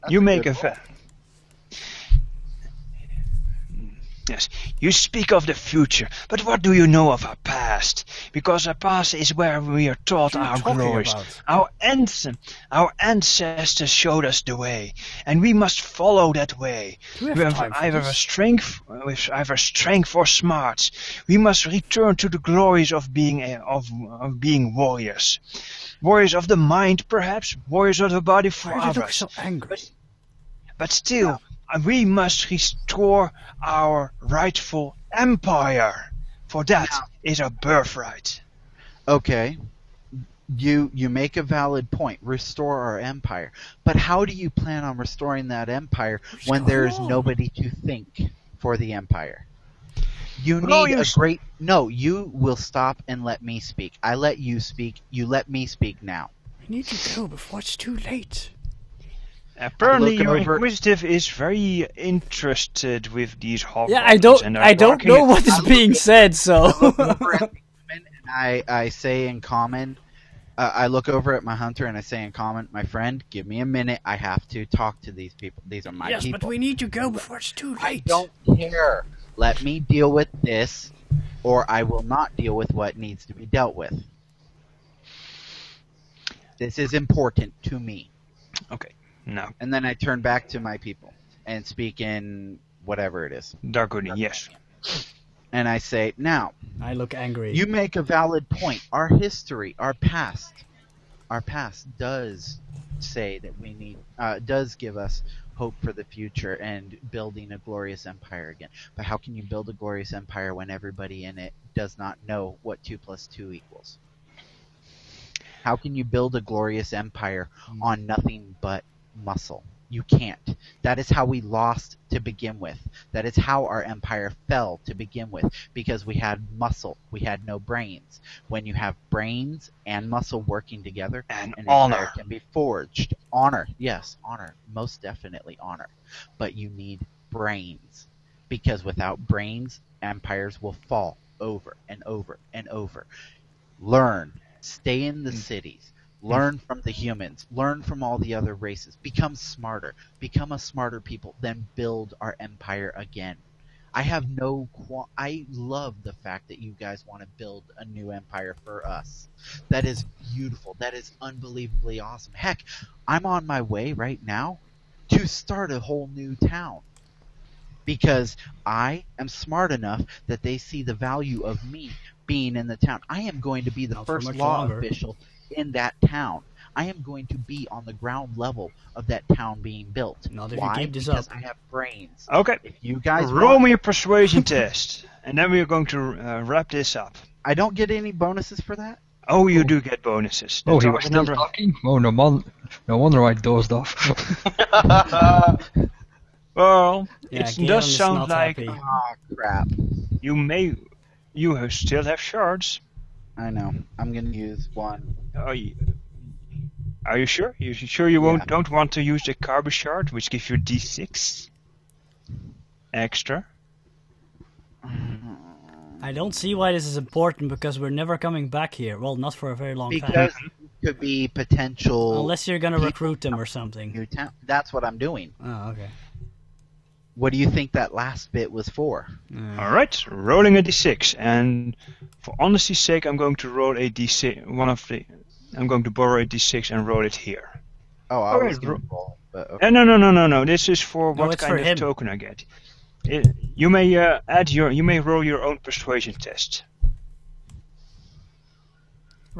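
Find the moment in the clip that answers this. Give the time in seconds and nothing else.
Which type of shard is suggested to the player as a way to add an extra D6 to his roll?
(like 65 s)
209 s.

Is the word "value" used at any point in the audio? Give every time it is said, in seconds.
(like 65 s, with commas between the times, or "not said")
170 s.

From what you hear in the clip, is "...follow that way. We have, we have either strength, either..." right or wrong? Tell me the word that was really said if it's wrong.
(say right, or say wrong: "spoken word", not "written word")
right.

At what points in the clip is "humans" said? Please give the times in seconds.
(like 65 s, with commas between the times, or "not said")
146 s.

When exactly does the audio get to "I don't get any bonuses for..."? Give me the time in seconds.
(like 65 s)
187 s.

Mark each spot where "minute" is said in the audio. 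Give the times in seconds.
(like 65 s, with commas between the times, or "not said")
73 s.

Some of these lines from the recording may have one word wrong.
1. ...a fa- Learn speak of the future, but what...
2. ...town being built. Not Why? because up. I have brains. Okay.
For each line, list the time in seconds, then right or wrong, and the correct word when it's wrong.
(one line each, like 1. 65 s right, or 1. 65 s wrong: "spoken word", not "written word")
1. 0 s wrong: "You", not "Learn"
2. 179 s right.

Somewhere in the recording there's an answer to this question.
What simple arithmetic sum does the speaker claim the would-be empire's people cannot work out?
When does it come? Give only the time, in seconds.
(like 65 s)
112 s.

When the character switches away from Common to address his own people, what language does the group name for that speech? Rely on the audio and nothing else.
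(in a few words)
Dargonian.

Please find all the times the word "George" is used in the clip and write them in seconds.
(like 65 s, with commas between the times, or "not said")
not said.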